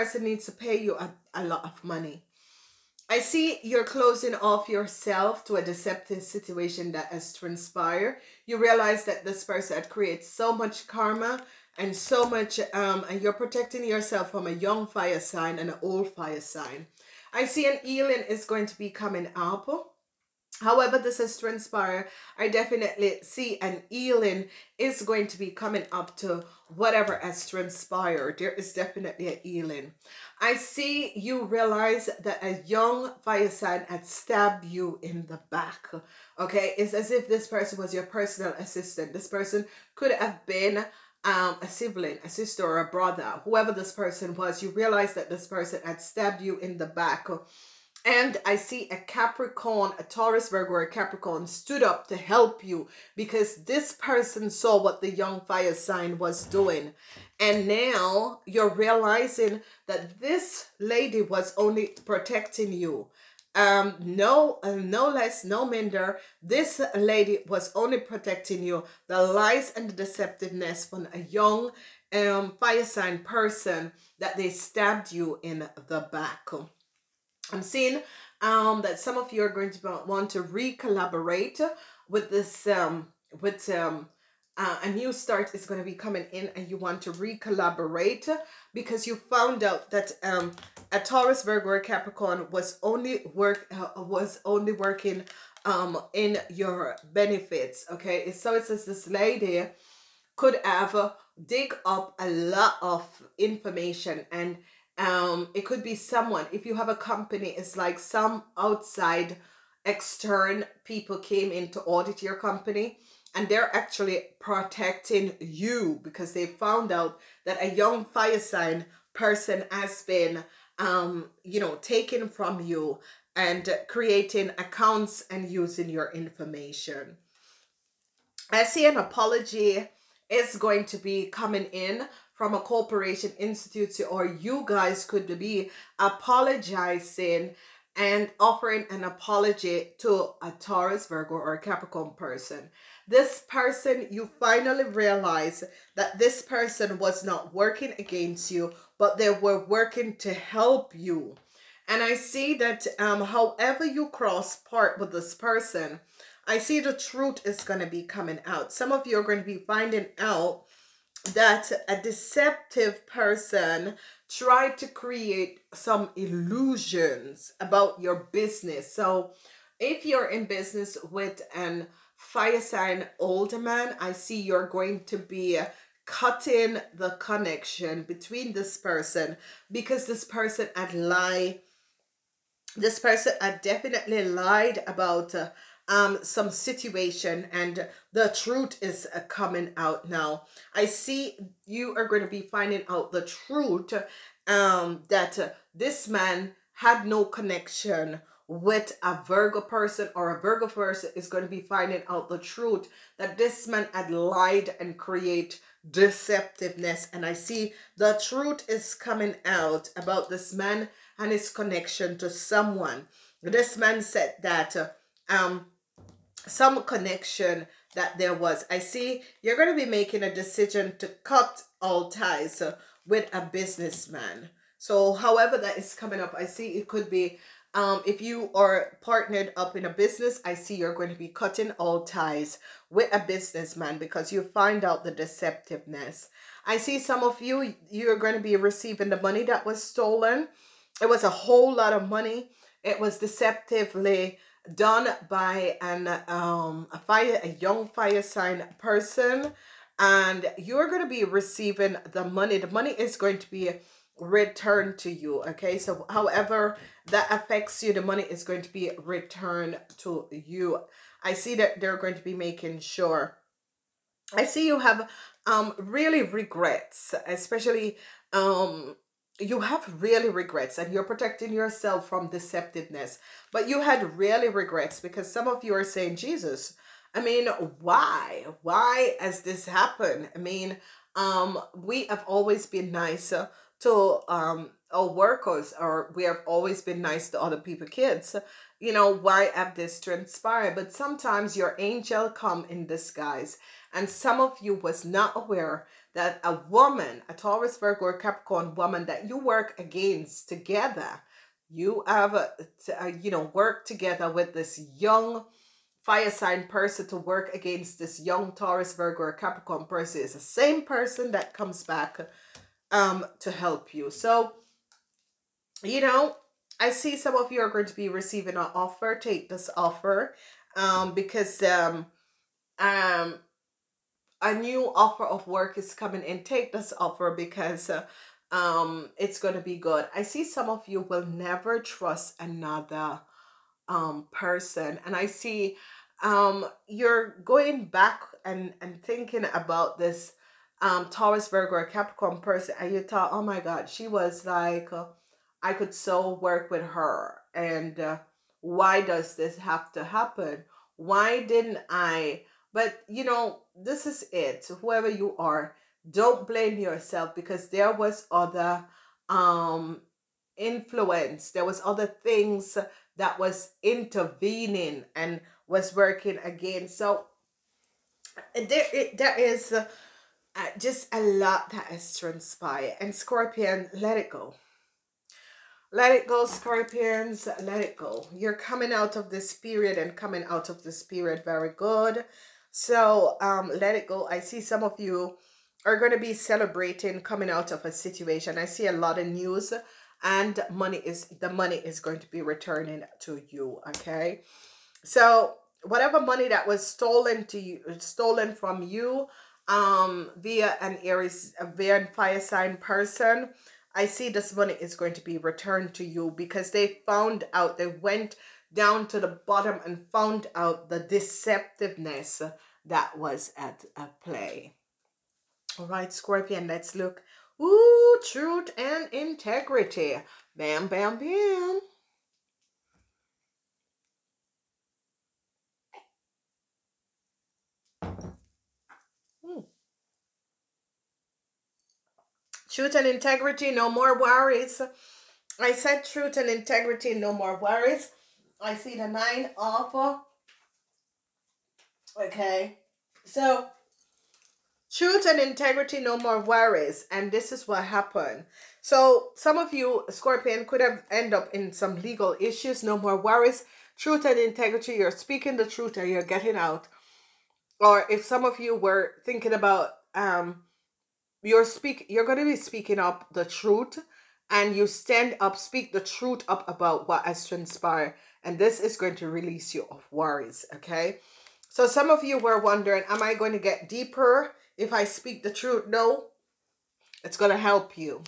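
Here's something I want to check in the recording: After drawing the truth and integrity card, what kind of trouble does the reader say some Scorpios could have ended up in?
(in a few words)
legal issues.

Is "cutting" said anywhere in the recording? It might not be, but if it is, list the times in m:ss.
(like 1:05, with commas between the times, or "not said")
2:56, 3:51.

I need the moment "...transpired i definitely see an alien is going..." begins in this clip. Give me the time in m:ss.
0:21.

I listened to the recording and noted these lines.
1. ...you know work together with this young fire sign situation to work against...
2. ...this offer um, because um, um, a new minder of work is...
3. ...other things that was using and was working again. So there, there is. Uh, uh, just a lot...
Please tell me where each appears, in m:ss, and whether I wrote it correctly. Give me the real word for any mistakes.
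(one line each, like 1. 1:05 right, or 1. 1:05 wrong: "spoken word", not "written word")
1. 5:03 wrong: "person", not "situation"
2. 5:19 wrong: "offer", not "minder"
3. 6:01 wrong: "intervening", not "using".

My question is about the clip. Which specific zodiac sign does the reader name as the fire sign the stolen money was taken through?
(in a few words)
Aries.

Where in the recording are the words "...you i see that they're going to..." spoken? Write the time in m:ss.
4:20.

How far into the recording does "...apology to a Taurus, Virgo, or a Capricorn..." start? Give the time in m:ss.
2:19.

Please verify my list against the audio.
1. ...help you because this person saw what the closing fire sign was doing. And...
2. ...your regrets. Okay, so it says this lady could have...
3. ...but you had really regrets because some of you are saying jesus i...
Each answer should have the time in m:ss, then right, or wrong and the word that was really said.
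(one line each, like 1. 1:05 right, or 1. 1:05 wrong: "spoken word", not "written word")
1. 0:52 wrong: "young", not "closing"
2. 1:36 wrong: "benefits", not "regrets"
3. 4:33 right.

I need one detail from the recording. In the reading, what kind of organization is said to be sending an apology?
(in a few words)
corporation institute.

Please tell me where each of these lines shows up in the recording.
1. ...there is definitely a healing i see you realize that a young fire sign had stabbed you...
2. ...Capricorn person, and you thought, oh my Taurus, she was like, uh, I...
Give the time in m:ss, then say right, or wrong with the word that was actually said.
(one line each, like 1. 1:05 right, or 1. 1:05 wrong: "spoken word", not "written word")
1. 0:28 right
2. 5:41 wrong: "God", not "Taurus".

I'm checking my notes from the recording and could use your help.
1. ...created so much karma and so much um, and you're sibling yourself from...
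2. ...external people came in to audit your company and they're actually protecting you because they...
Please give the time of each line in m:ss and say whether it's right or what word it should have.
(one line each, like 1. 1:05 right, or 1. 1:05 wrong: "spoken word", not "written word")
1. 0:09 wrong: "protecting", not "sibling"
2. 1:49 right.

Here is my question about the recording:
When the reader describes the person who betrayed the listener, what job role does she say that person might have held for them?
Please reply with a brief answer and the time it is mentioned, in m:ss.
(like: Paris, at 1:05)
personal assistant, at 0:38.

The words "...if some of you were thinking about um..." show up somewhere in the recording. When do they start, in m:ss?
7:38.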